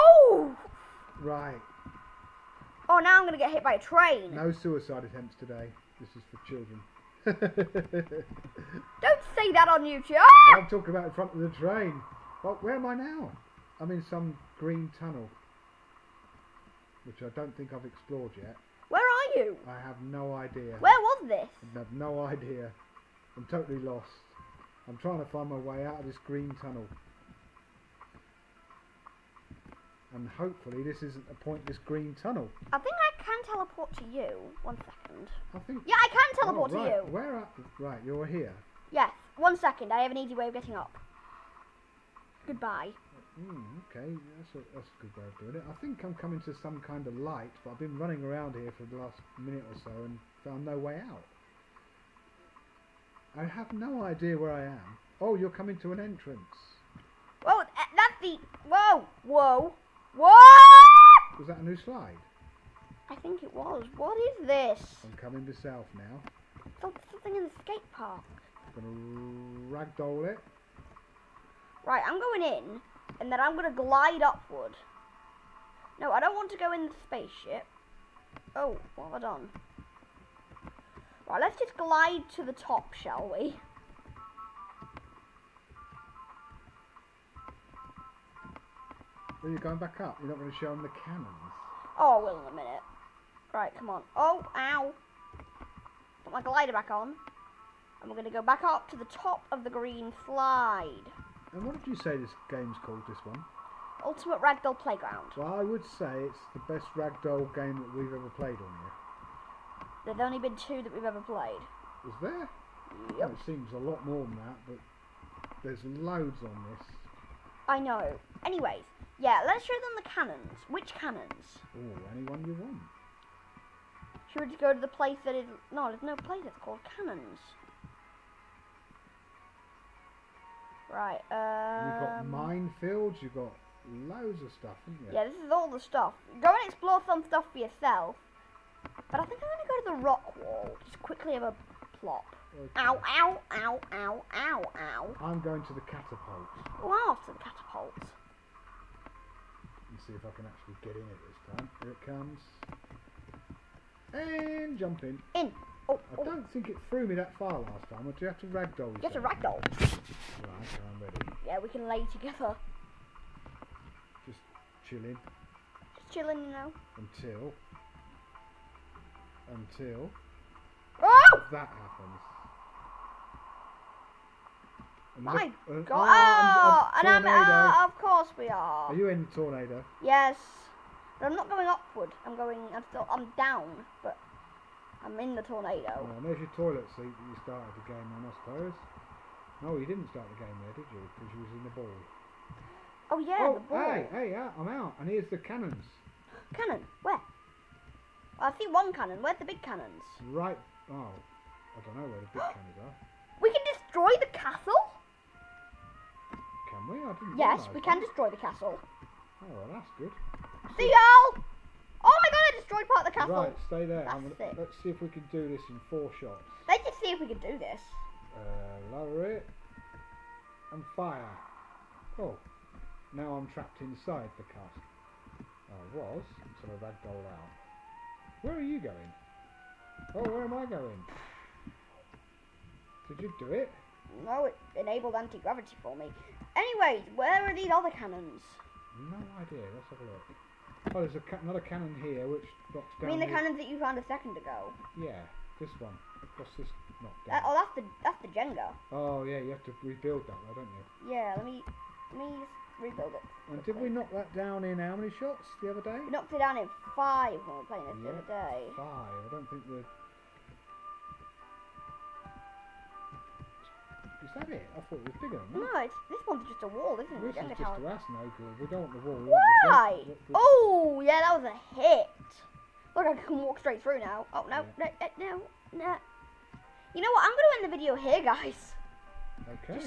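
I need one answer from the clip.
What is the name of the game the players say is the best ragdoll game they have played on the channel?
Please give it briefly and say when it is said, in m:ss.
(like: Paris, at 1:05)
Ultimate Ragdoll Playground, at 1:44.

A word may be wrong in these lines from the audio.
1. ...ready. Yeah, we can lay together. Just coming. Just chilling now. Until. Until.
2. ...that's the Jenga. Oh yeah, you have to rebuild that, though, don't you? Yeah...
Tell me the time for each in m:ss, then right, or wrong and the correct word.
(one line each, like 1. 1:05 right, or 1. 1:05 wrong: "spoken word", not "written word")
1. 2:41 wrong: "chilling", not "coming"
2. 4:08 right.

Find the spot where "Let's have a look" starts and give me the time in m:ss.
3:59.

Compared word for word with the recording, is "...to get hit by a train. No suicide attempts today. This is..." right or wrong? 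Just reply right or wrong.
right.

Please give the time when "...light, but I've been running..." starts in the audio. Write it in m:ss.
0:47.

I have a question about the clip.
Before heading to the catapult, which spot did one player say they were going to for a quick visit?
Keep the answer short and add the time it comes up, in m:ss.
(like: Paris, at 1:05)
the rock wall, at 2:19.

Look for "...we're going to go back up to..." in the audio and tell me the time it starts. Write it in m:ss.
1:38.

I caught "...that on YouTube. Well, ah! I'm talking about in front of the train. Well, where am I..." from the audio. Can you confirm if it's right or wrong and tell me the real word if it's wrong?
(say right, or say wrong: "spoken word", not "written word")
right.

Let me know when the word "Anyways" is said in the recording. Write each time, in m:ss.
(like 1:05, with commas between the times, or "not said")
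1:58, 3:56.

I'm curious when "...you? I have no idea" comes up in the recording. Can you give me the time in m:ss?
0:19.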